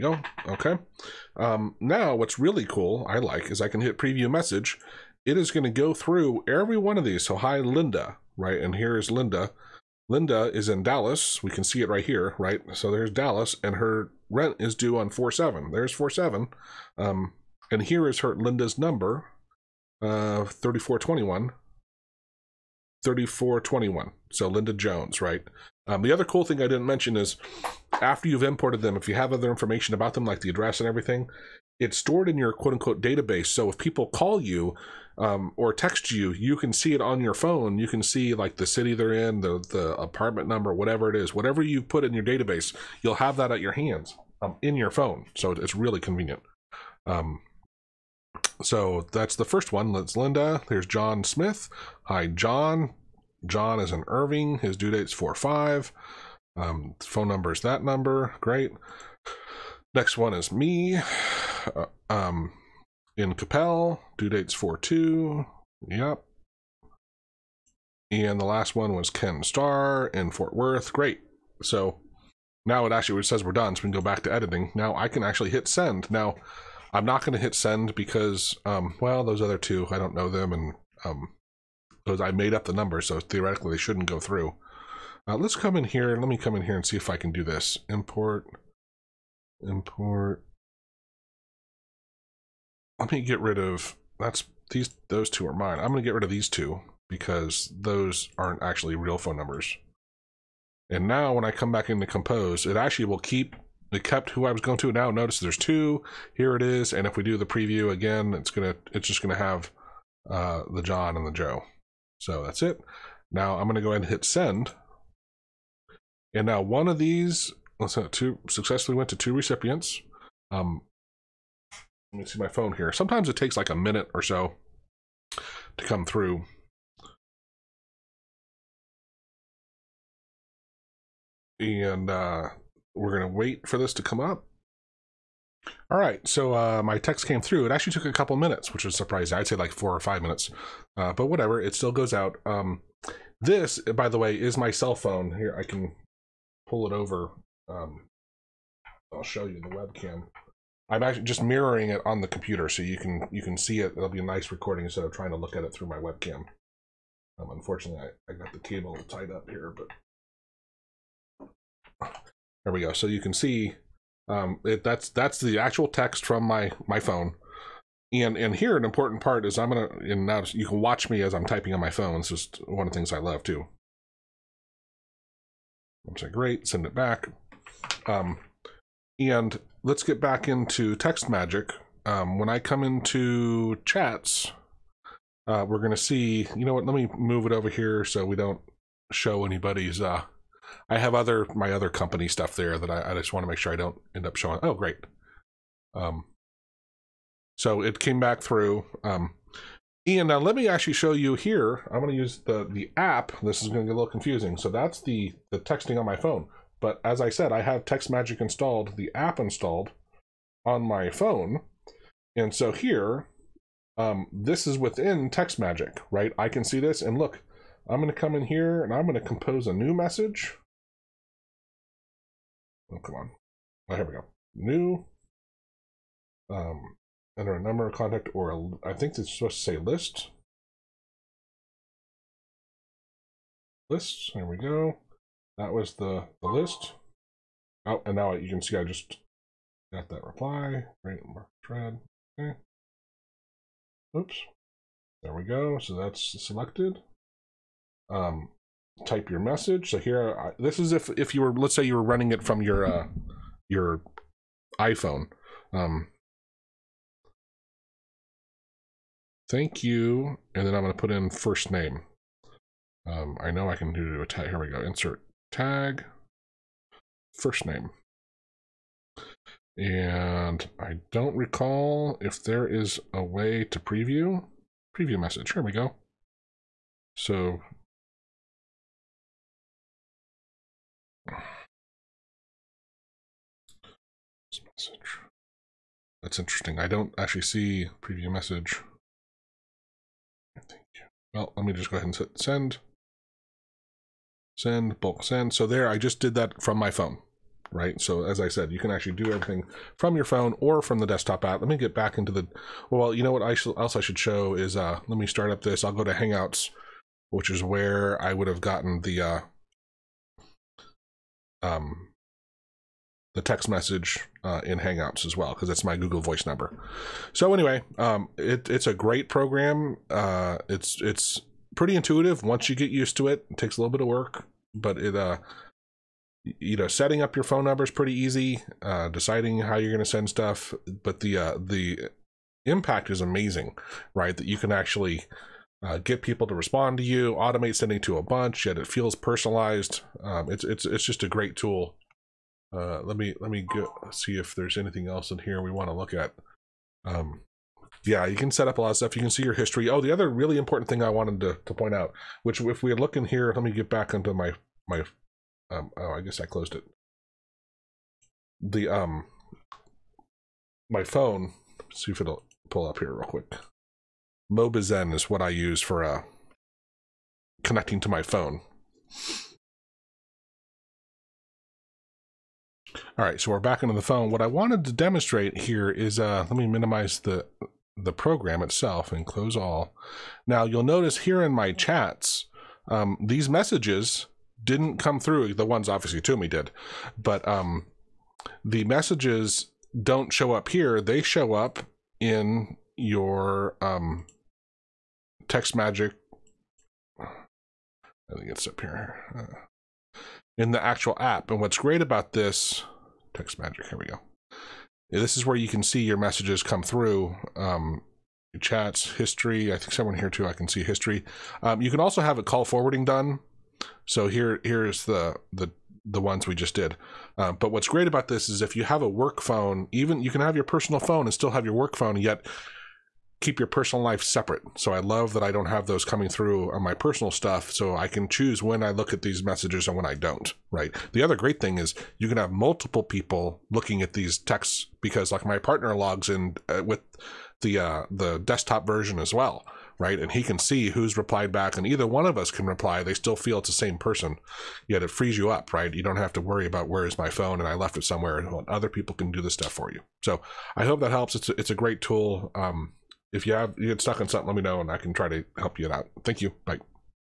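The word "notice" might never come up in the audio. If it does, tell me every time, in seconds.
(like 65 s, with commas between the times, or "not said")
105 s, 380 s.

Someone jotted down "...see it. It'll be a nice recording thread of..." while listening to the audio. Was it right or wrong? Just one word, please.
wrong.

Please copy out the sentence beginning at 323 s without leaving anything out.
It takes a little bit of work, but it uh you know setting up your phone number is pretty easy.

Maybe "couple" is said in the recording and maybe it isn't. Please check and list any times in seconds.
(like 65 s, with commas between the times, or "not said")
138 s.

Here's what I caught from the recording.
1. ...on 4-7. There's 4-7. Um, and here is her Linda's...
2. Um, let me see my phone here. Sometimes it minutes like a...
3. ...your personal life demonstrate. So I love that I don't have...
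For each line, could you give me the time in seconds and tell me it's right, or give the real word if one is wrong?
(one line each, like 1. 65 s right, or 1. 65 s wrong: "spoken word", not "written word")
1. 14 s right
2. 120 s wrong: "takes", not "minutes"
3. 423 s wrong: "separate", not "demonstrate".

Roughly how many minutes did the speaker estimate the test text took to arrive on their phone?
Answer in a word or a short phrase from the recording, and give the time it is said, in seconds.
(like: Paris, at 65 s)
4 or 5 minutes, at 139 s.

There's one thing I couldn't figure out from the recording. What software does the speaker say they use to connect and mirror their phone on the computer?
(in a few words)
Mobizen.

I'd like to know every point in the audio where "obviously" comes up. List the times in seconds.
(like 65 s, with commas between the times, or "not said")
385 s.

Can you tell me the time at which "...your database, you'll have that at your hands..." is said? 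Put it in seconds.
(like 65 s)
42 s.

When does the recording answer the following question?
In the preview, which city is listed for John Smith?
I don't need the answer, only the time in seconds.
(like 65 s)
53 s.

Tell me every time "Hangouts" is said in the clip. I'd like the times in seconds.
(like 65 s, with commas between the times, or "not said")
306 s, 314 s.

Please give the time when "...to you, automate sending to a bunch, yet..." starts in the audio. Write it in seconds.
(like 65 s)
336 s.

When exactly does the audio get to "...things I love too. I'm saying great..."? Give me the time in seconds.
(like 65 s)
172 s.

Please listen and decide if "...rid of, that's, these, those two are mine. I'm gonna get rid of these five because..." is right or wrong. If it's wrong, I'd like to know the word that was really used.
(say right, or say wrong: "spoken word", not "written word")
wrong: "two", not "five".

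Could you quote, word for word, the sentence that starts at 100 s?
And now when I come back into compose, it actually will keep, it kept who I was going to.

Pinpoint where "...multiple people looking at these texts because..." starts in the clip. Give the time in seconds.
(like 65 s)
432 s.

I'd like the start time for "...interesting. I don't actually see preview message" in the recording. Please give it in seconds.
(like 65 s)
286 s.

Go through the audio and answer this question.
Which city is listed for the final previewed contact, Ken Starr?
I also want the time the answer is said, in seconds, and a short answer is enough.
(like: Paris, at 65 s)
Fort Worth, at 70 s.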